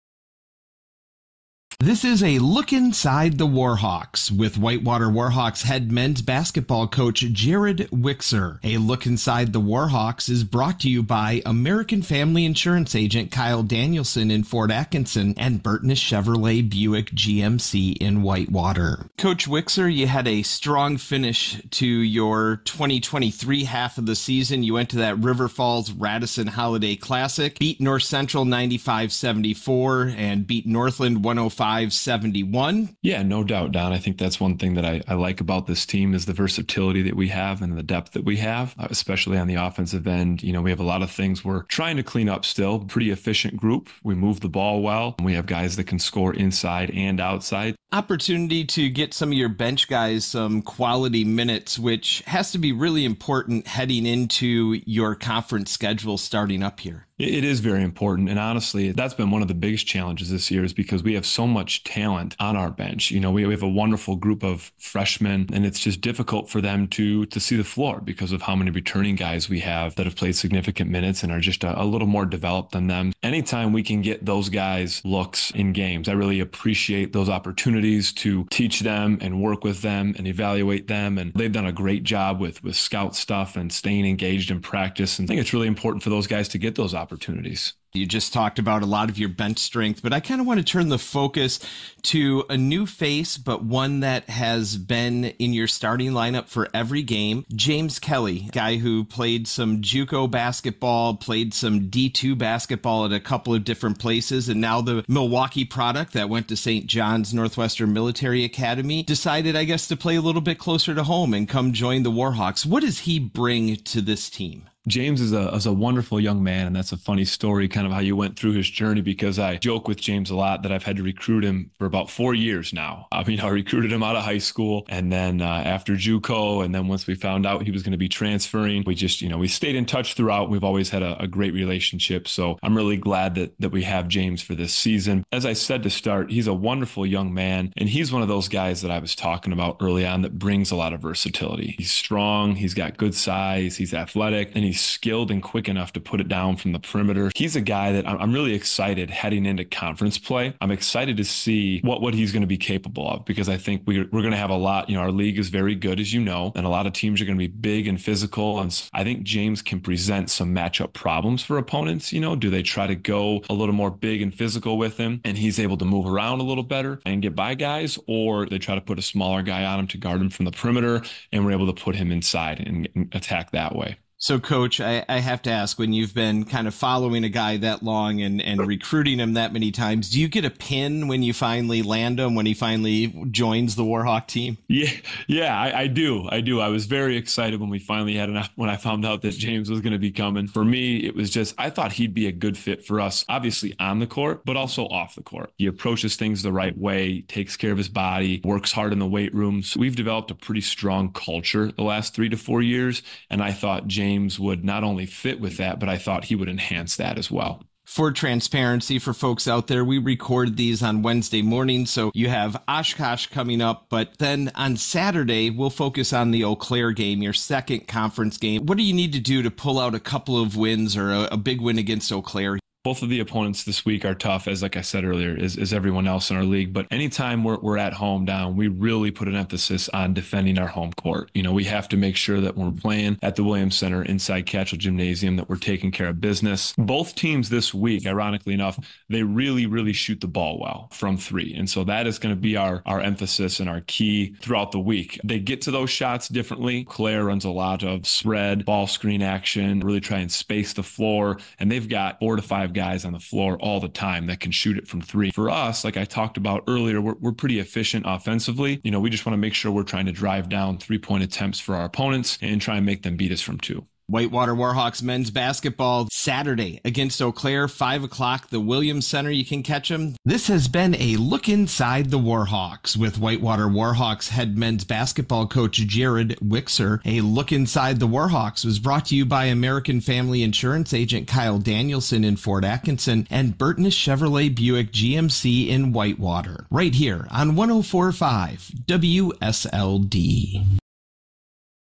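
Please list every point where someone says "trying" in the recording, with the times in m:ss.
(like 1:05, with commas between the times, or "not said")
0:41, 4:19.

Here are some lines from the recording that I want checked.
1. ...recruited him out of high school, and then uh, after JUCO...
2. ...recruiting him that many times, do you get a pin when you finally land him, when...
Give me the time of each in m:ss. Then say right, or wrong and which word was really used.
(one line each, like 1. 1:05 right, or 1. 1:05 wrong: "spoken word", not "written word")
1. 2:03 right
2. 2:58 right.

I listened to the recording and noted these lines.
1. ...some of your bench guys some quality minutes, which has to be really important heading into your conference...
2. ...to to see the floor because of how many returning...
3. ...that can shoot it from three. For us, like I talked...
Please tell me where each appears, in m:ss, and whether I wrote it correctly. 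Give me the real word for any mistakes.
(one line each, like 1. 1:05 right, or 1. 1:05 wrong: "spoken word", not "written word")
1. 0:49 right
2. 1:06 right
3. 4:14 right.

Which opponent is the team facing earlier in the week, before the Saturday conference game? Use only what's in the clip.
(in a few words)
Oshkosh.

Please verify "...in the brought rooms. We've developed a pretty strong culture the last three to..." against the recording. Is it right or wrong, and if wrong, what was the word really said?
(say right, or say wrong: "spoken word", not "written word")
wrong: "weight", not "brought".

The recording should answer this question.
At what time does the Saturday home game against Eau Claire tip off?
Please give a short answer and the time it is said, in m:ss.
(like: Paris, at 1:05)
5 o'clock, at 4:27.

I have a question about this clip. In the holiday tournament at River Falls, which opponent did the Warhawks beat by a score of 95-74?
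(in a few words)
North Central.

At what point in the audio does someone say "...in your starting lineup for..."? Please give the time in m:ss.
1:35.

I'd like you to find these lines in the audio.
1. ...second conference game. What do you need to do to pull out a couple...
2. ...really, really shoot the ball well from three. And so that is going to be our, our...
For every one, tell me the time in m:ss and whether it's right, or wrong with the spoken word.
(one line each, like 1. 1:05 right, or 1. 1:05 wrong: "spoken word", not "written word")
1. 3:37 right
2. 3:59 right.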